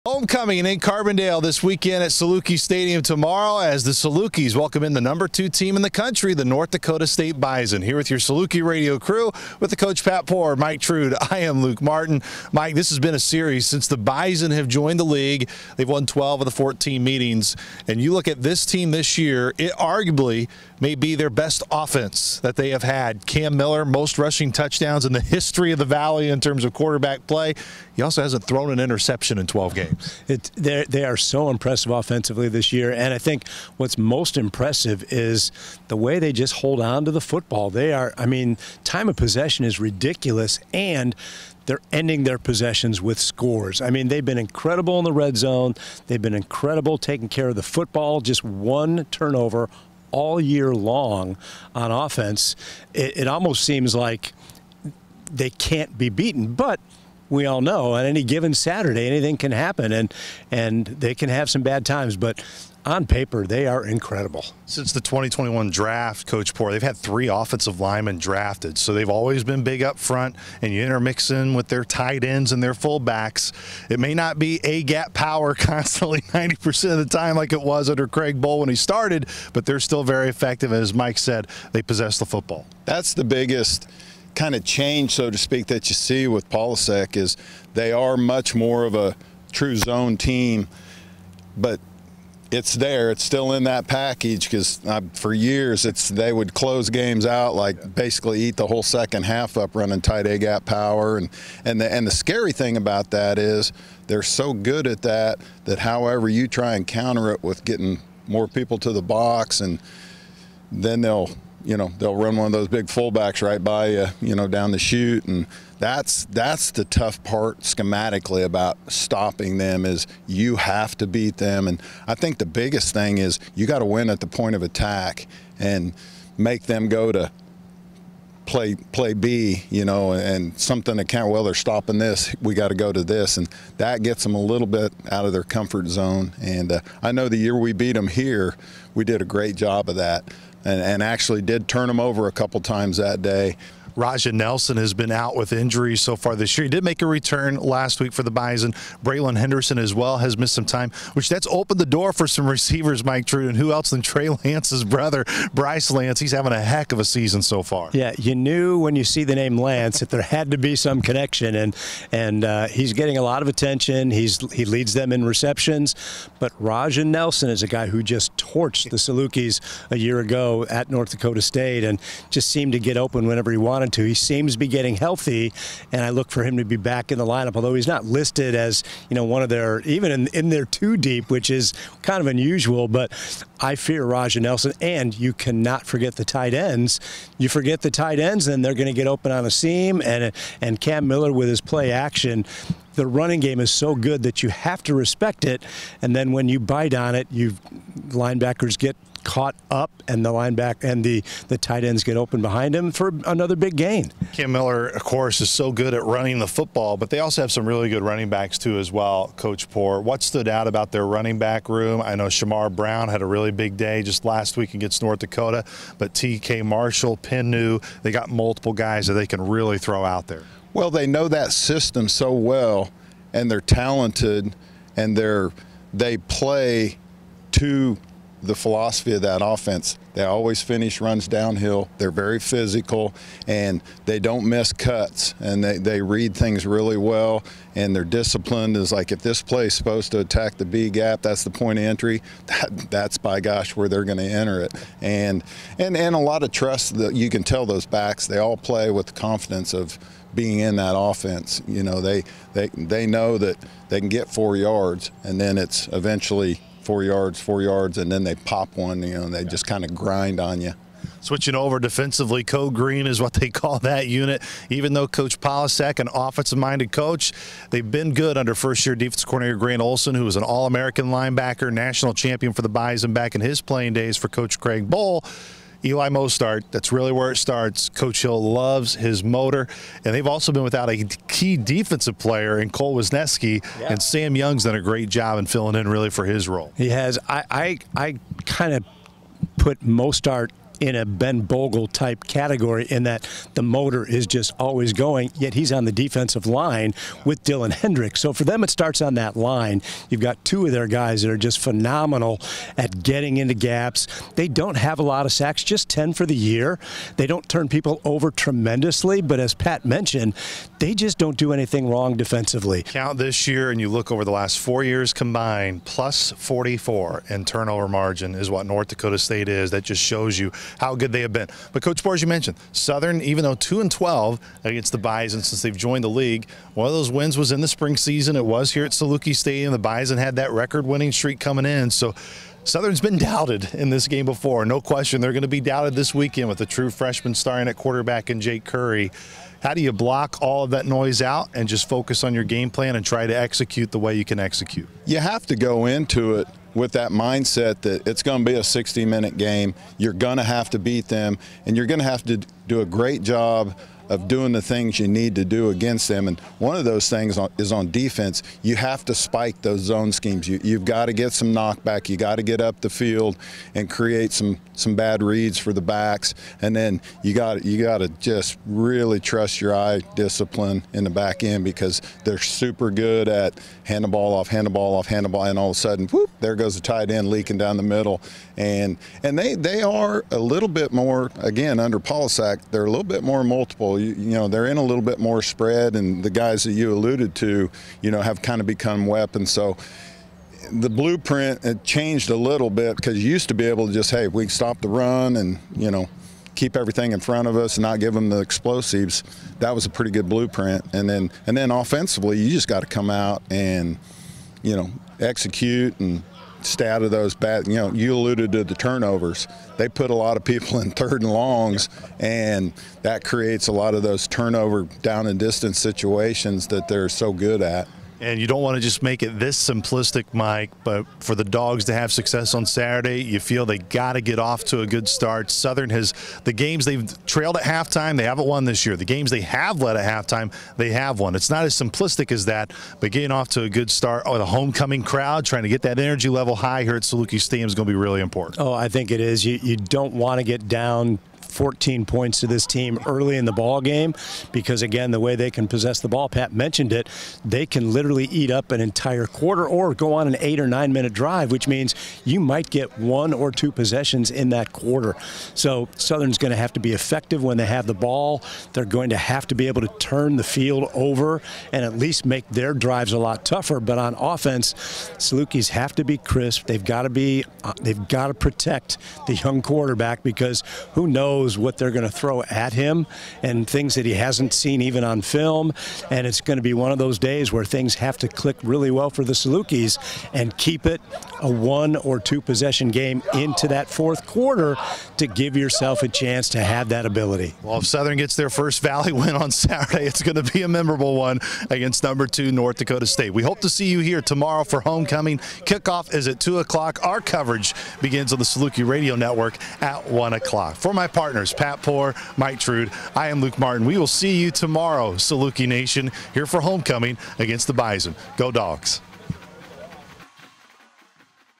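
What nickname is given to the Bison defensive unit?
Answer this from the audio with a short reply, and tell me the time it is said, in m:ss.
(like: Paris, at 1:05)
Code Green, at 4:22.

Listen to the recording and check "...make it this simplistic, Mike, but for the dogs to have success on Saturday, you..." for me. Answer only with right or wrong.
right.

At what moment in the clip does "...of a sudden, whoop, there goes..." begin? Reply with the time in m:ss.
6:15.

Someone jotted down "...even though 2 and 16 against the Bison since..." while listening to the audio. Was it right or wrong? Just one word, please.
wrong.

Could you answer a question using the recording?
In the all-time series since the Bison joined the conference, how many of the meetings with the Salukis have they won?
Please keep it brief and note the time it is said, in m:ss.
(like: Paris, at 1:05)
12, at 0:16.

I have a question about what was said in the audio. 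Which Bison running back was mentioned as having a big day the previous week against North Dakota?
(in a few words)
Shamar Brown.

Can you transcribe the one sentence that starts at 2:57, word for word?
Although he's not listed as you know one of their even in, in their two deep, which is kind of unusual.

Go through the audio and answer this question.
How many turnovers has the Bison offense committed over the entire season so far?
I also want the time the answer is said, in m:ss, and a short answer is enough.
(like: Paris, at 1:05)
1, at 0:48.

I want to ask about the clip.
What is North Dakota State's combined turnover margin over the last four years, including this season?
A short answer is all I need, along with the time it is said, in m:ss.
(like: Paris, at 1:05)
+44, at 5:15.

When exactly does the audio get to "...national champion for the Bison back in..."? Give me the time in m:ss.
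4:31.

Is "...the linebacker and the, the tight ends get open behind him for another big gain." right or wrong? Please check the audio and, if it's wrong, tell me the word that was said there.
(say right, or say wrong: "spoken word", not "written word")
right.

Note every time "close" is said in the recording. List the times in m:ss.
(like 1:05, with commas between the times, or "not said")
1:36.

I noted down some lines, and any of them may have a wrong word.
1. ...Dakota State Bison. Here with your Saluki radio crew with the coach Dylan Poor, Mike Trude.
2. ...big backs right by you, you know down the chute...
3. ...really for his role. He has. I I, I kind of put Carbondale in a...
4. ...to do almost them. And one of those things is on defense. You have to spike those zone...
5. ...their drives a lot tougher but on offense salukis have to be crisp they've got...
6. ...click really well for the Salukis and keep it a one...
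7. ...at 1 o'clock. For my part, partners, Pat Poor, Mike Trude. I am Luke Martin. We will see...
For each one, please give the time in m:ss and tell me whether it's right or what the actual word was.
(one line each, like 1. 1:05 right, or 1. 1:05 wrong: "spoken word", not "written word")
1. 0:06 wrong: "Pat", not "Dylan"
2. 1:52 wrong: "fullbacks", not "backs"
3. 4:45 wrong: "Mostaert", not "Carbondale"
4. 5:55 wrong: "against", not "almost"
5. 7:42 right
6. 7:58 right
7. 8:19 right.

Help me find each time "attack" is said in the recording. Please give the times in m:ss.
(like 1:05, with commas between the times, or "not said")
2:04, 4:00.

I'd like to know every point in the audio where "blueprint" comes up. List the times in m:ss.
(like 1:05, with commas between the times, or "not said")
6:30, 6:40.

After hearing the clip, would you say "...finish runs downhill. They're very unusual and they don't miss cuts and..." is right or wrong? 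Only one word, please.
wrong.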